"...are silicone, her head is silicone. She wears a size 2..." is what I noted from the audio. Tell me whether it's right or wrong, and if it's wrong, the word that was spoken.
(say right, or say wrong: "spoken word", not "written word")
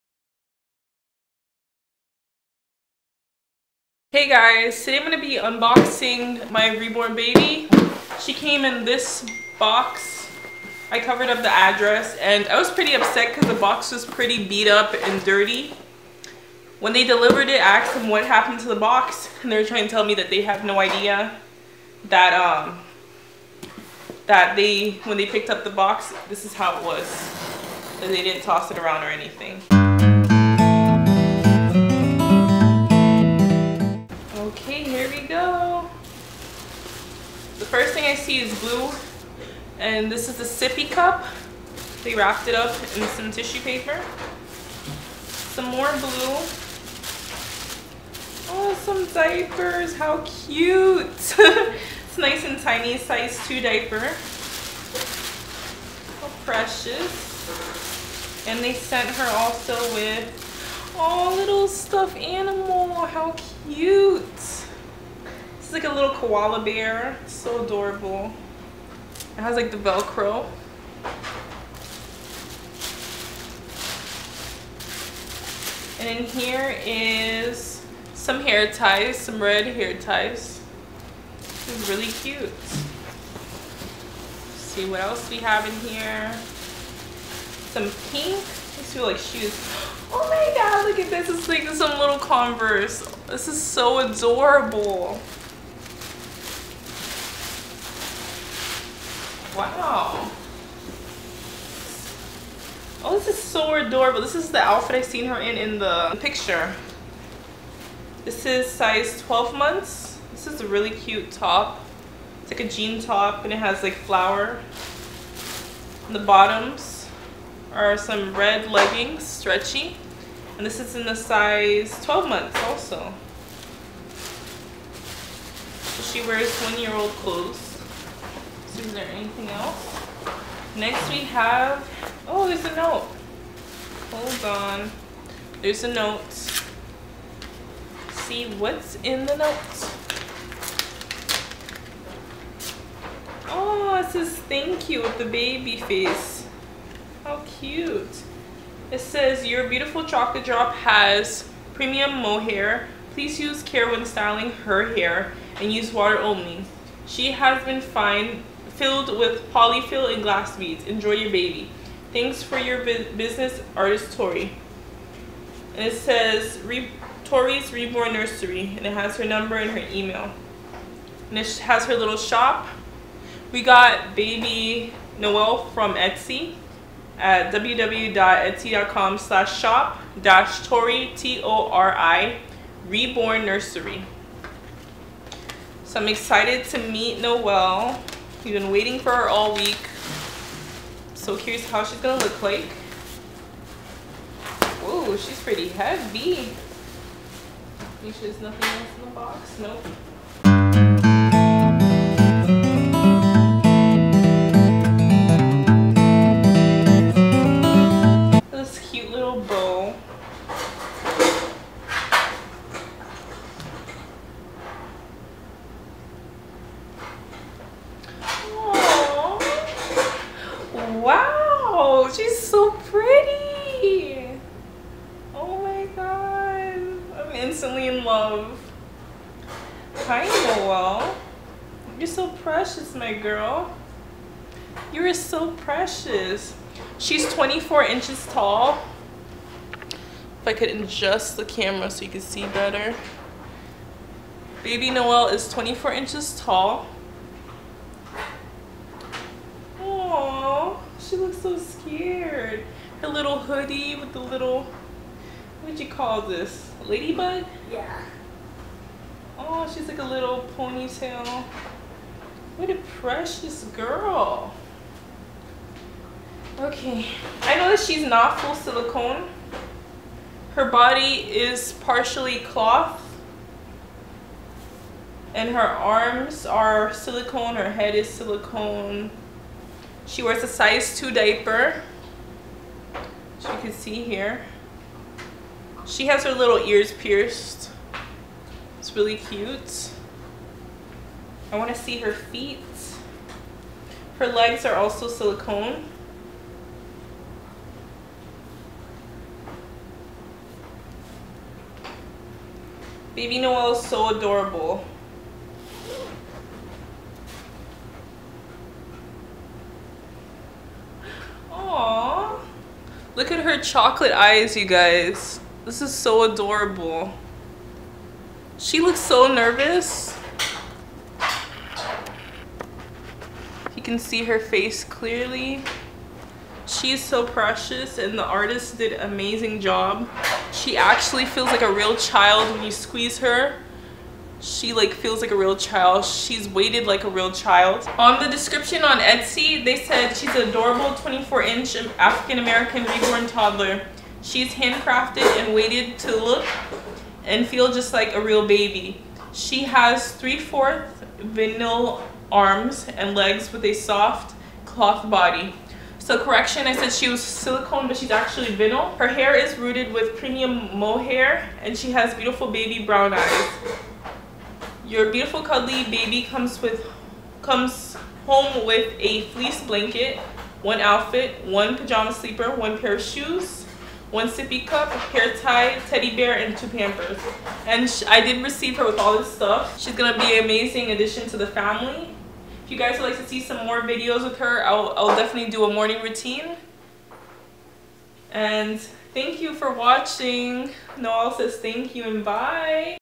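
right.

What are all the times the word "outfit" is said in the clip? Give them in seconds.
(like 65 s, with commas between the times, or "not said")
104 s, 370 s.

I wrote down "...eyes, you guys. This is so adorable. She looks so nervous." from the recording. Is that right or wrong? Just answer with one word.
right.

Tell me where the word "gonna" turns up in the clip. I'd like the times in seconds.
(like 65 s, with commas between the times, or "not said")
192 s, 379 s.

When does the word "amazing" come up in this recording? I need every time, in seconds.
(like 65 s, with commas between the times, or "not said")
329 s, 380 s.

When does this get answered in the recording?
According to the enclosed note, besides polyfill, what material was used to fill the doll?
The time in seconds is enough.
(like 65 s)
160 s.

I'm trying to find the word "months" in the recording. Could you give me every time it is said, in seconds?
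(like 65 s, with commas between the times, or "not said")
109 s, 122 s.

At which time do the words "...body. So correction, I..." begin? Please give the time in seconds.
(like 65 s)
355 s.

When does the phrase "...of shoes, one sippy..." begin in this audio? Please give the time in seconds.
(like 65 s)
372 s.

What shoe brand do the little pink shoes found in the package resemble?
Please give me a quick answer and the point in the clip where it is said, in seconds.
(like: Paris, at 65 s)
Converse, at 92 s.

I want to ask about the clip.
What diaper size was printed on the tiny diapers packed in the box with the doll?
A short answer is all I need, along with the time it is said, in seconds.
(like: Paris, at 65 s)
size 2, at 52 s.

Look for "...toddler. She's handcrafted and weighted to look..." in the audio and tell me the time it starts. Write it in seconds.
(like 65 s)
343 s.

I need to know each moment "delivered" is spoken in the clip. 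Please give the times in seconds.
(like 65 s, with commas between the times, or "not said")
17 s.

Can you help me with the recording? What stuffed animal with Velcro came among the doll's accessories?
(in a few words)
koala bear.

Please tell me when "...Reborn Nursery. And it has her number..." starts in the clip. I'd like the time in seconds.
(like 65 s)
167 s.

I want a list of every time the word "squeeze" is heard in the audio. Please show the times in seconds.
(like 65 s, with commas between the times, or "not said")
332 s.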